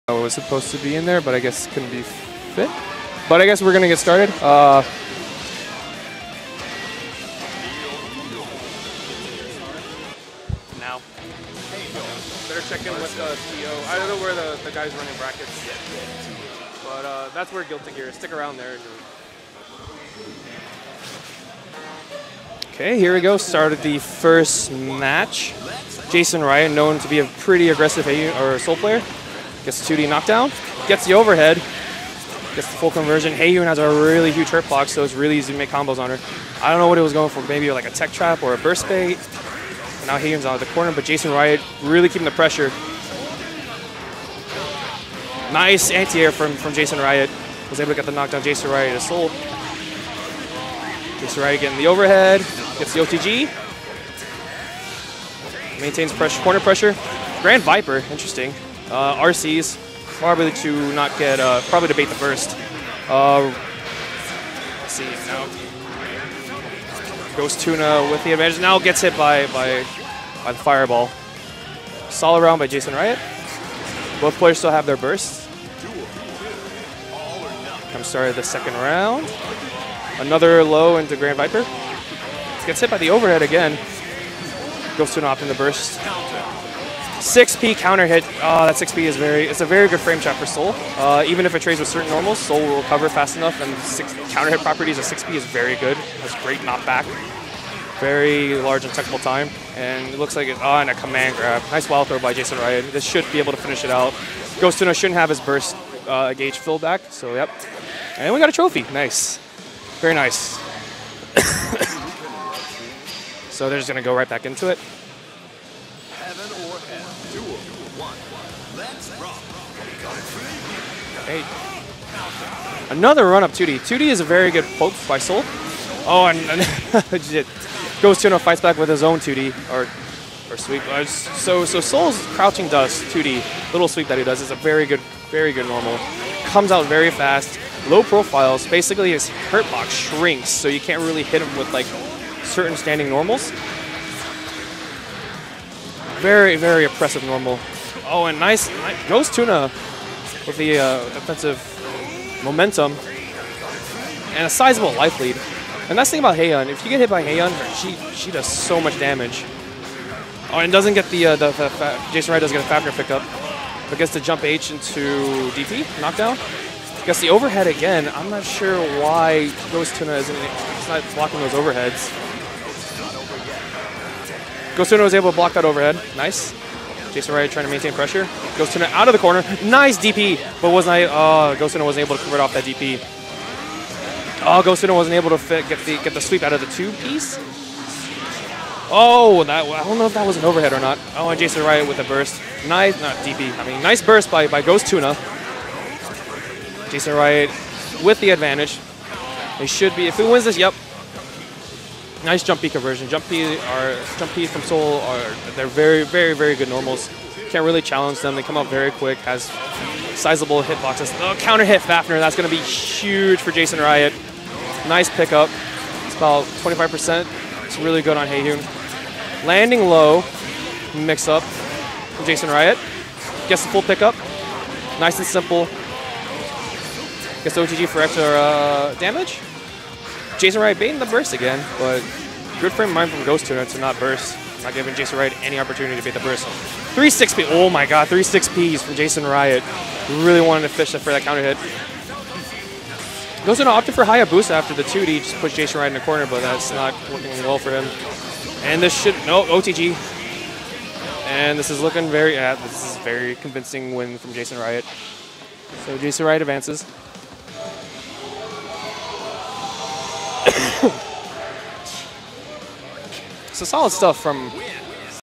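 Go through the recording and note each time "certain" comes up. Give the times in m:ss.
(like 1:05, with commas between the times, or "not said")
1:31, 2:22.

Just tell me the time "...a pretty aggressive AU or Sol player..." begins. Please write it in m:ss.
0:27.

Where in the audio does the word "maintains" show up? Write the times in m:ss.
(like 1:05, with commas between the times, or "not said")
0:55, 2:57.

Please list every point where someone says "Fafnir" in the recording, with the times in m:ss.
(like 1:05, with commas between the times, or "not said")
2:42, 3:31.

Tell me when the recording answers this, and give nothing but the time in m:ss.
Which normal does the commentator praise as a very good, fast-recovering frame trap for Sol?
1:28.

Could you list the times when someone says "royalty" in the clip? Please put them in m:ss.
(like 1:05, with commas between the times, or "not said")
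not said.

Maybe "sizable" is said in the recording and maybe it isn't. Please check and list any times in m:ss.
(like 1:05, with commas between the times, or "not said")
2:34, 3:30.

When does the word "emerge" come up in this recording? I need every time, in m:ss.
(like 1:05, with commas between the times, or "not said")
not said.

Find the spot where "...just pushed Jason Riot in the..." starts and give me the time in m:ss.
4:05.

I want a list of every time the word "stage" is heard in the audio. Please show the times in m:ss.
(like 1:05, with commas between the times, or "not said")
not said.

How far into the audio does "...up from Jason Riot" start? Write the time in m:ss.
3:41.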